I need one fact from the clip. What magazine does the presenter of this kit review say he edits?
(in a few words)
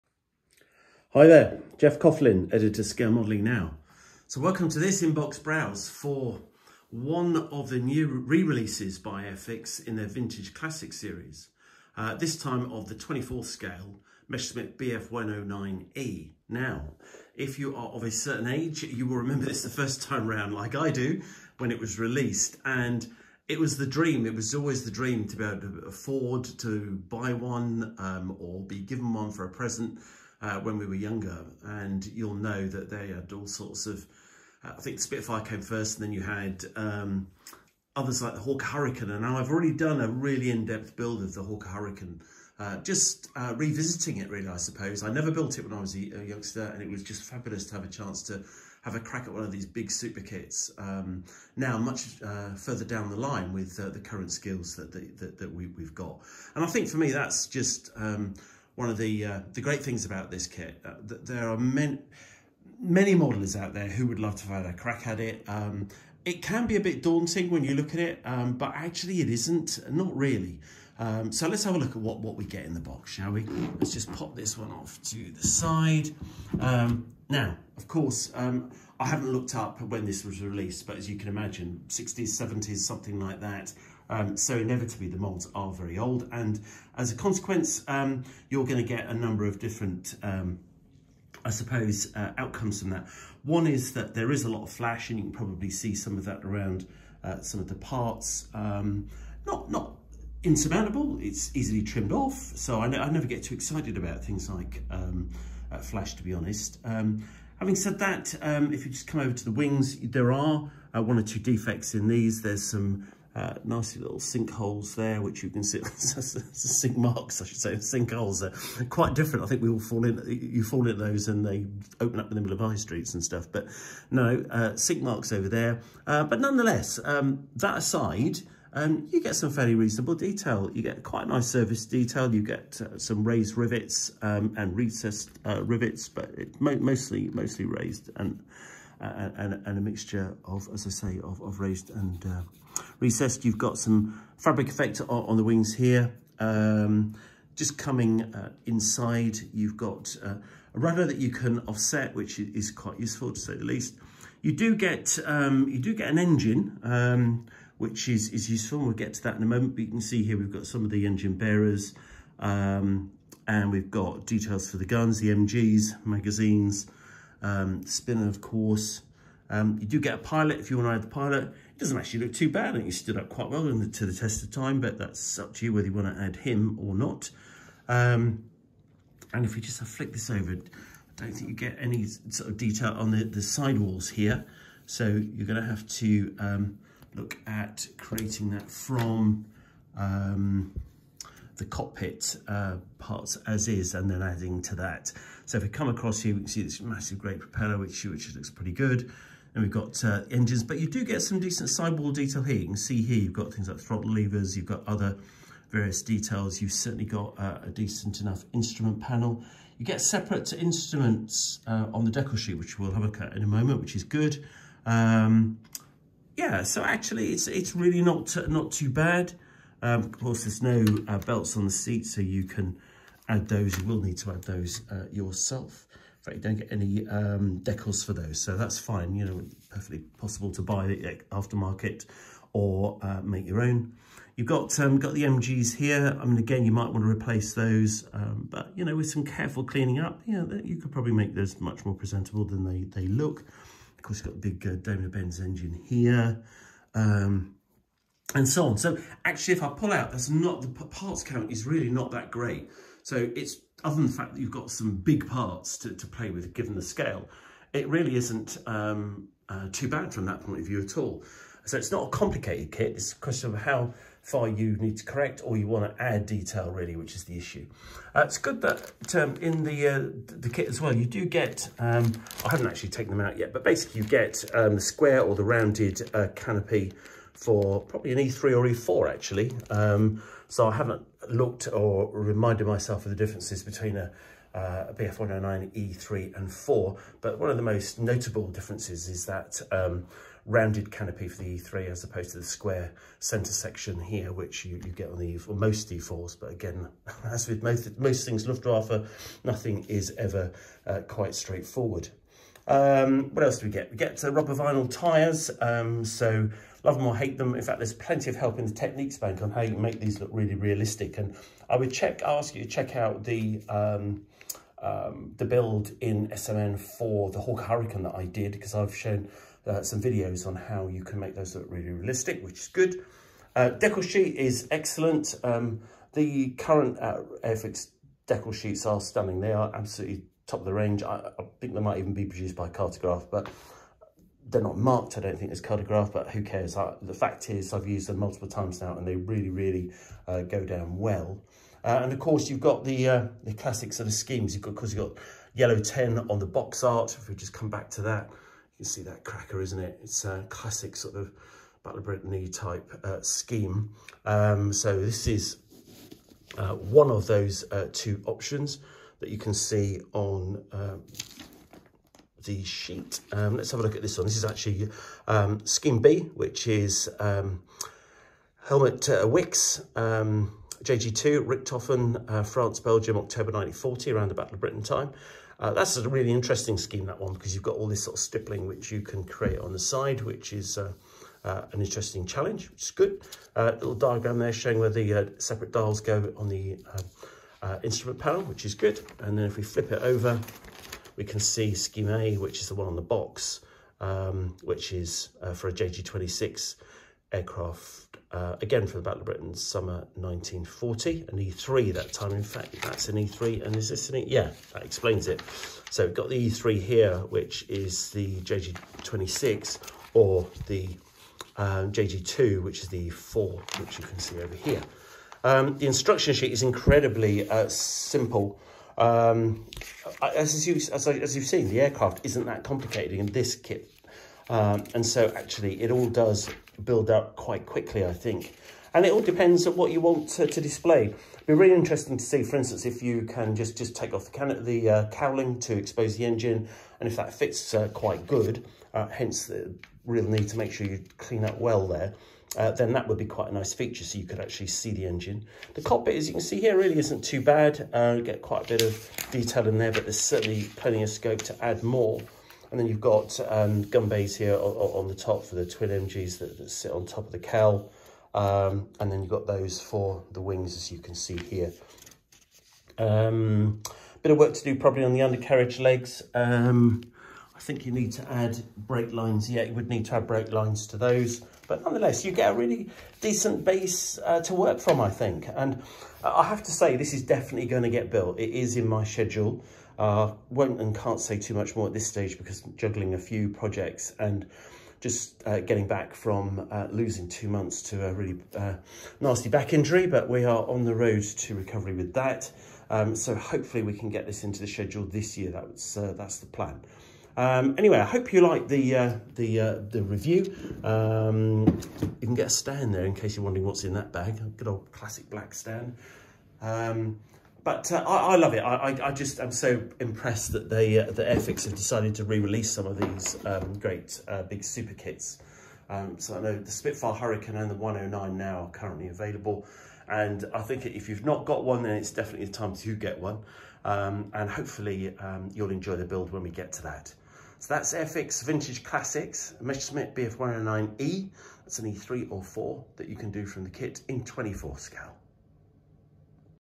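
Scale Modeling Now.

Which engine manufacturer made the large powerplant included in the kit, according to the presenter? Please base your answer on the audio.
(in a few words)
Daimler Benz.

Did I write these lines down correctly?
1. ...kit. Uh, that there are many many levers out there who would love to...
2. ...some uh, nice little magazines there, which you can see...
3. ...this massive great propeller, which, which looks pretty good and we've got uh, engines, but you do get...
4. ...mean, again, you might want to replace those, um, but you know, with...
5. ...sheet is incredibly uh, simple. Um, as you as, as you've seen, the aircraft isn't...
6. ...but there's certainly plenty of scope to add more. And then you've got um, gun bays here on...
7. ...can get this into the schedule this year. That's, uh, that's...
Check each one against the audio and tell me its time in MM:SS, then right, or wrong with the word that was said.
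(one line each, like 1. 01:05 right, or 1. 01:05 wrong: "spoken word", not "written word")
1. 01:00 wrong: "modelers", not "levers"
2. 01:52 wrong: "sinkholes", not "magazines"
3. 03:16 right
4. 03:56 right
5. 06:56 right
6. 07:29 right
7. 08:13 right.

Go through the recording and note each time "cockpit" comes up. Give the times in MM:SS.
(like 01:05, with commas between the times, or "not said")
03:11, 07:25.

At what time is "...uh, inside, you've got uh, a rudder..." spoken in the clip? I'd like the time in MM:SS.
02:28.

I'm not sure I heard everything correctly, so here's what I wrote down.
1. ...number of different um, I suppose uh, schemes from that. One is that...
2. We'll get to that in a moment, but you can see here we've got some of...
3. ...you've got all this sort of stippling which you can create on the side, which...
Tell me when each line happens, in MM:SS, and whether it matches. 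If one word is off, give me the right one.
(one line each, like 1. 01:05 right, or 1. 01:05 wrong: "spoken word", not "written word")
1. 01:29 wrong: "outcomes", not "schemes"
2. 02:38 right
3. 06:17 right.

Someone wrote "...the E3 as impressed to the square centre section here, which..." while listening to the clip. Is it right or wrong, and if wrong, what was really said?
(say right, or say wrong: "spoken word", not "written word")
wrong: "opposed", not "impressed".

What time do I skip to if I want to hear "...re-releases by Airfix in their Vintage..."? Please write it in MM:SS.
00:08.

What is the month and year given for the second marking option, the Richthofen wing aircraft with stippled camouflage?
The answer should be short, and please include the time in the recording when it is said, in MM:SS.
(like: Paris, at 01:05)
October 1940, at 06:13.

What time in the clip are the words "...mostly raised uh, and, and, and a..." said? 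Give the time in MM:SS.
02:17.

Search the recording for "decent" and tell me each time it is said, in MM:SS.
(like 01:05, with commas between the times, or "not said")
03:21, 03:27, 07:53.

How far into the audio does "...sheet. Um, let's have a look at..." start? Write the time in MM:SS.
06:02.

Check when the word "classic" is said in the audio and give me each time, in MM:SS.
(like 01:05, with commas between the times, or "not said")
00:10, 05:43, 05:50, 08:24, 08:48.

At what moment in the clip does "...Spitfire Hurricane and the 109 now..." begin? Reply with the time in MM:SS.
08:36.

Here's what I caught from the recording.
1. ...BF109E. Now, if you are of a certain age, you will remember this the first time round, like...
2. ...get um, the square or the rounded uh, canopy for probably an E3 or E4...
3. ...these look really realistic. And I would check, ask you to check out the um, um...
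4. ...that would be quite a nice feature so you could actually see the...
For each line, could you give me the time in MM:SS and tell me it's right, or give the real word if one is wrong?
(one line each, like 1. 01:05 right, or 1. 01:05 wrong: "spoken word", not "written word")
1. 00:14 right
2. 04:34 right
3. 05:09 right
4. 07:22 right.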